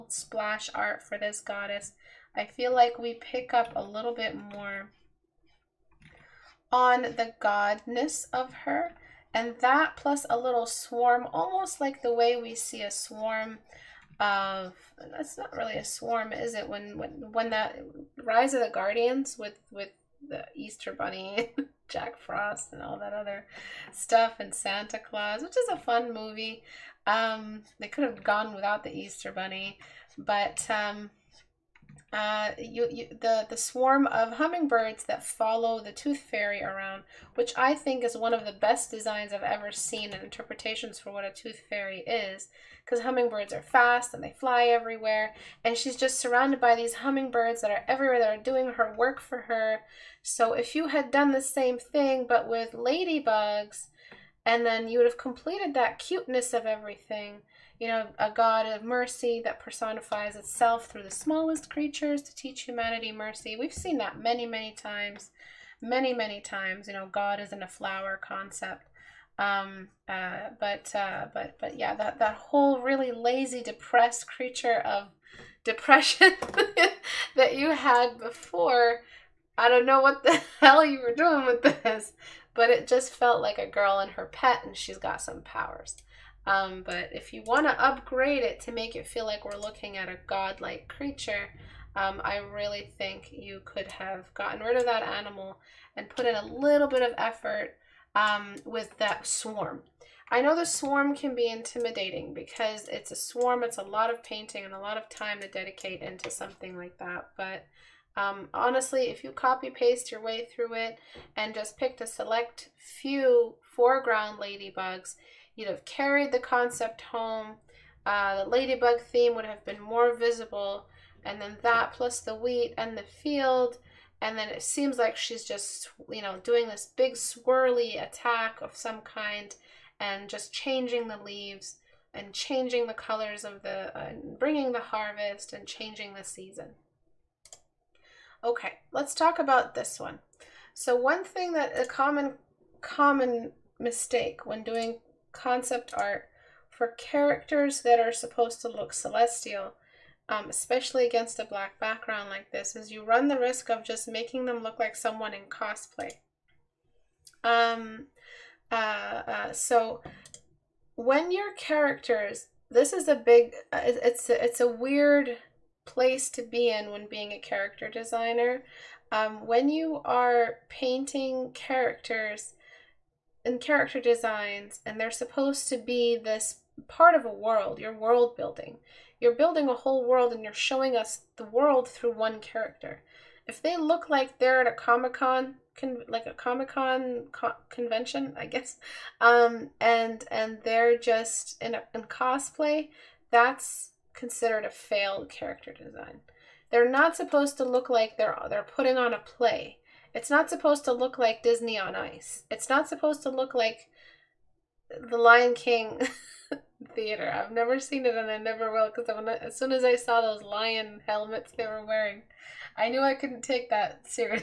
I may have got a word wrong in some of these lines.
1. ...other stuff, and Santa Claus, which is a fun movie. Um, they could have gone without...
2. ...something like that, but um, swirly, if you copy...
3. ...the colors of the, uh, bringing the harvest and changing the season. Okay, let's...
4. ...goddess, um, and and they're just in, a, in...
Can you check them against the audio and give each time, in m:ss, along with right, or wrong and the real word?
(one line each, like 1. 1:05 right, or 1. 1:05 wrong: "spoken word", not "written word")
1. 0:23 right
2. 1:46 wrong: "honestly", not "swirly"
3. 2:12 right
4. 3:08 wrong: "guess", not "goddess".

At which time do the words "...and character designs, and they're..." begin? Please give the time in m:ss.
2:53.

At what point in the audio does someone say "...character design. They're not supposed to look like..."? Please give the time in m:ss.
3:15.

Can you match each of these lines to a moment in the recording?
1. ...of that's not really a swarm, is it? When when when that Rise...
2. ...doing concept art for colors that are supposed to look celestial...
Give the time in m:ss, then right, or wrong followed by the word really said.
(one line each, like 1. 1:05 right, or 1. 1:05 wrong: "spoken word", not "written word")
1. 0:14 right
2. 2:24 wrong: "characters", not "colors".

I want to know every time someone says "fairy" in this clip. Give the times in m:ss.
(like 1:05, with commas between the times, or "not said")
0:36, 0:41.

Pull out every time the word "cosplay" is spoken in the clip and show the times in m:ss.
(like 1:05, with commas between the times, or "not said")
2:35, 3:12.